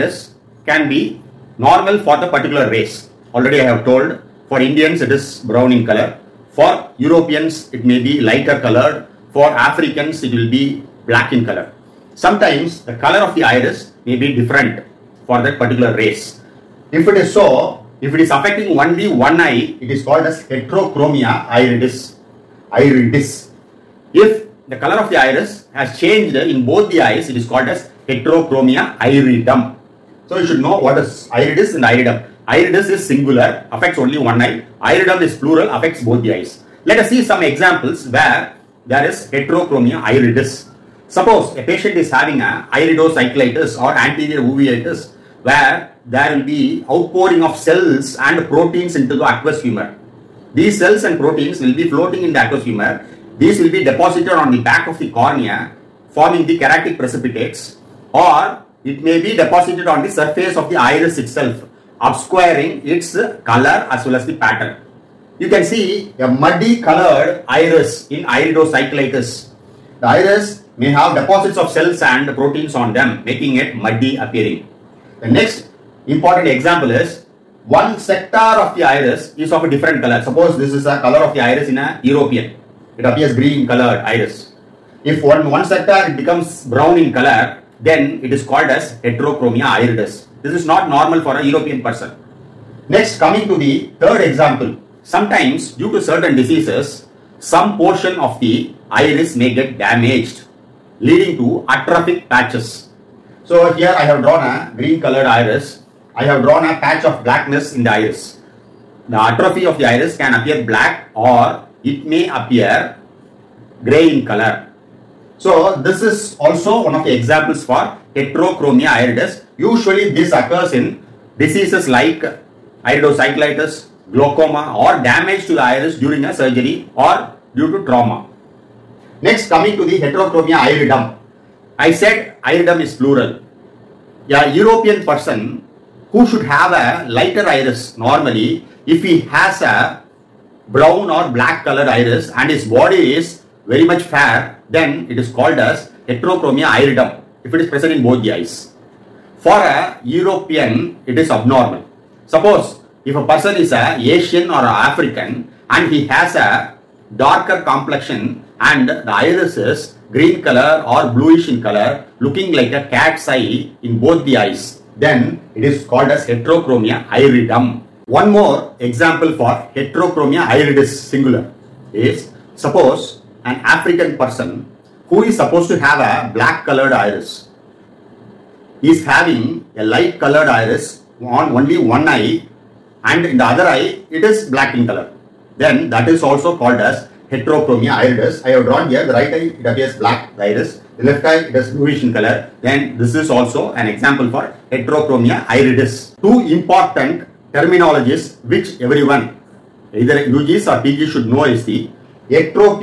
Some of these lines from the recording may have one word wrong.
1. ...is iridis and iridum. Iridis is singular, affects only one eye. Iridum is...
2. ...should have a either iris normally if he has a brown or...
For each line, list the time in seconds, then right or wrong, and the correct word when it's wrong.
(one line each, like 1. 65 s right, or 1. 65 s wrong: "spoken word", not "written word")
1. 30 s right
2. 136 s wrong: "lighter", not "either".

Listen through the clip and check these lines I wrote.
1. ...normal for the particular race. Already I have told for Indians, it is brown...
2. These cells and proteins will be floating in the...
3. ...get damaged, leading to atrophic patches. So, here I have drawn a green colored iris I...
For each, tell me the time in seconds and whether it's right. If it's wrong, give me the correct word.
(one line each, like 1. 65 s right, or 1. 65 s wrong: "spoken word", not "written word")
1. 1 s right
2. 50 s right
3. 99 s right.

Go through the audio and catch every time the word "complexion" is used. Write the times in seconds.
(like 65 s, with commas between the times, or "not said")
157 s.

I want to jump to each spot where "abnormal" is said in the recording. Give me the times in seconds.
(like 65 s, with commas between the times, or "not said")
151 s.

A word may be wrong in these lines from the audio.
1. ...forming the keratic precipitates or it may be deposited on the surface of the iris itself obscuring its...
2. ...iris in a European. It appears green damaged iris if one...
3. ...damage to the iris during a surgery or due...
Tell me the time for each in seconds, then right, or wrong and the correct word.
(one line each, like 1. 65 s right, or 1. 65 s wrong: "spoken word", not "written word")
1. 56 s right
2. 81 s wrong: "colored", not "damaged"
3. 125 s right.